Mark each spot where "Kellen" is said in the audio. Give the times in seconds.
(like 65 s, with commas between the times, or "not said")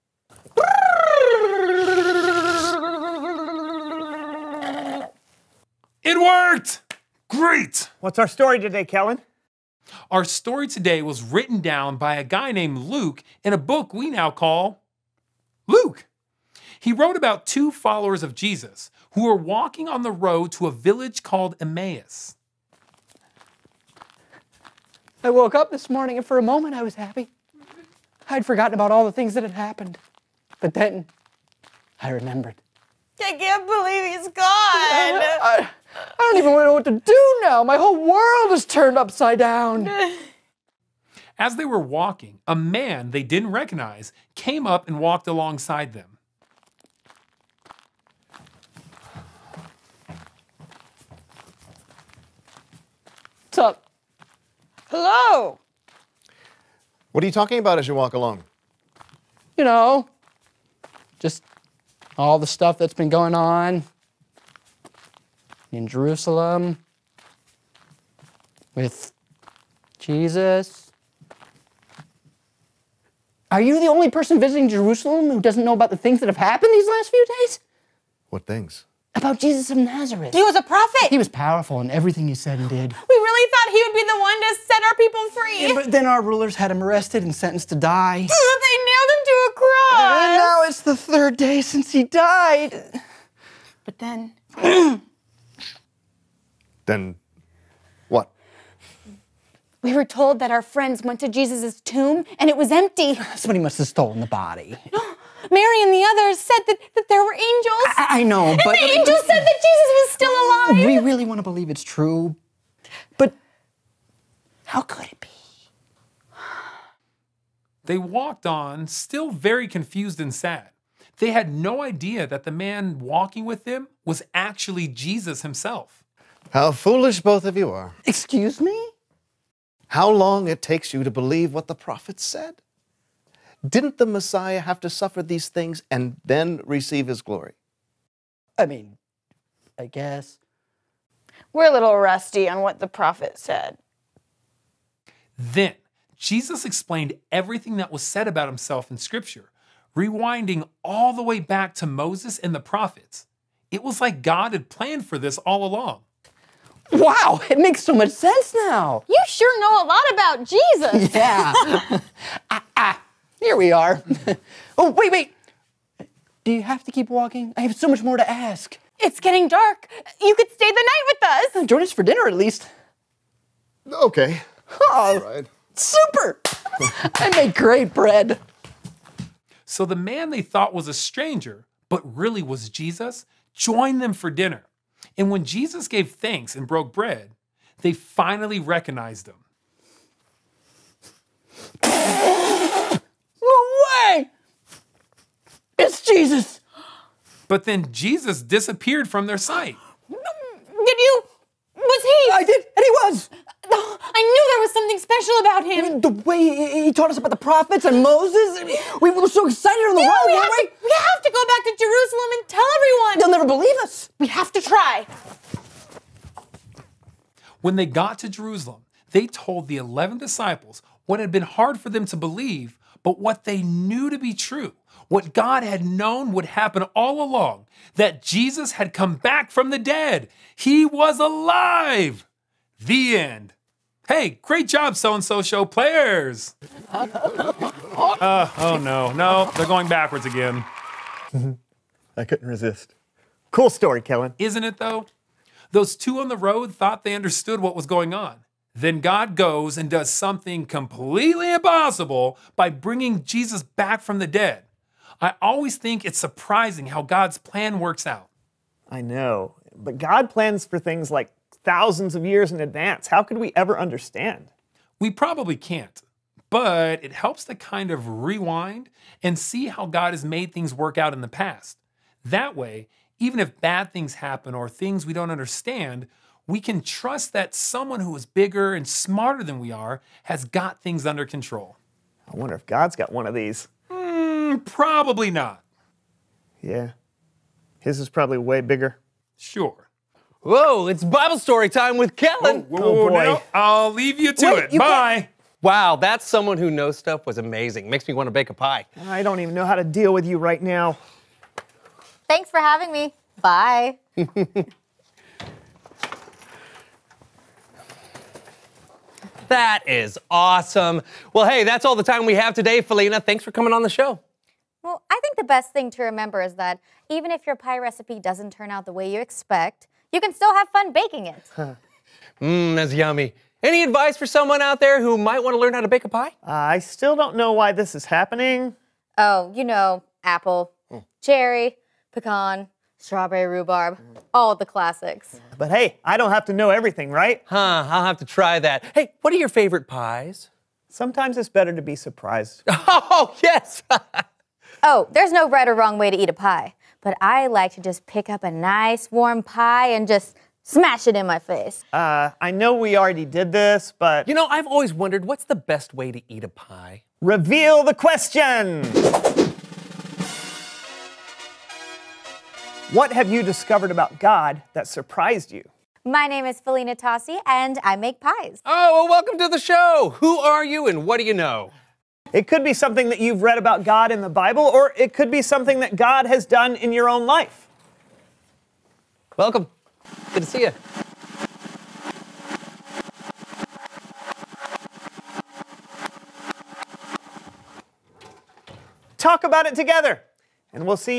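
8 s, 244 s, 292 s.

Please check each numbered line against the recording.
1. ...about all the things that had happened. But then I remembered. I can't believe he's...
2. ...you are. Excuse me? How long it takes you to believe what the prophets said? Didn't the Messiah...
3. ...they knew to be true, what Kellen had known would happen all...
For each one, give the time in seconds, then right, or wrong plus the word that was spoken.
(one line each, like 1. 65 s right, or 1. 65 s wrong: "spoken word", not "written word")
1. 28 s right
2. 127 s right
3. 223 s wrong: "God", not "Kellen".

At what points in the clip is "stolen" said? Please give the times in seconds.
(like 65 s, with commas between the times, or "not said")
103 s.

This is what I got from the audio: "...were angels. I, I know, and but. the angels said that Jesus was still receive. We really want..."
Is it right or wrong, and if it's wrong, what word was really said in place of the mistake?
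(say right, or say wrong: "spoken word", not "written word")
wrong: "alive", not "receive".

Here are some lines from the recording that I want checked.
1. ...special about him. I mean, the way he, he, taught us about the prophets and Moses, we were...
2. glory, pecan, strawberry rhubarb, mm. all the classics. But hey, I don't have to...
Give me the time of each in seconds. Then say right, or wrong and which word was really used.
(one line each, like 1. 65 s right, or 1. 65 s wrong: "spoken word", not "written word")
1. 204 s right
2. 331 s wrong: "cherry", not "glory".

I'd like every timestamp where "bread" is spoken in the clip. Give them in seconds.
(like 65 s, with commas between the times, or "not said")
177 s, 186 s.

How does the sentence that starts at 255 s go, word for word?
I always think it's surprising how God's plan works out.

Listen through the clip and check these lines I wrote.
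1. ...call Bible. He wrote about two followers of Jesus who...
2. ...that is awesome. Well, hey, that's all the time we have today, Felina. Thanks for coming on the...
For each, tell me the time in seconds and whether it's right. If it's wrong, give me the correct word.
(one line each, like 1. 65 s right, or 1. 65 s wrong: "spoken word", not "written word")
1. 14 s wrong: "Luke", not "Bible"
2. 309 s right.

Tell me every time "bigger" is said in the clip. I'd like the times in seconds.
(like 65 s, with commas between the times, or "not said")
278 s, 288 s.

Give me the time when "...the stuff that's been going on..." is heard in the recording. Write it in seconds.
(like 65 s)
62 s.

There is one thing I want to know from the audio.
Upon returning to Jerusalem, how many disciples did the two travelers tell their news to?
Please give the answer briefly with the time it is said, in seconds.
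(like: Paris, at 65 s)
11, at 219 s.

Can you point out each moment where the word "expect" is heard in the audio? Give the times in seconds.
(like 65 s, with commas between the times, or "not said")
319 s.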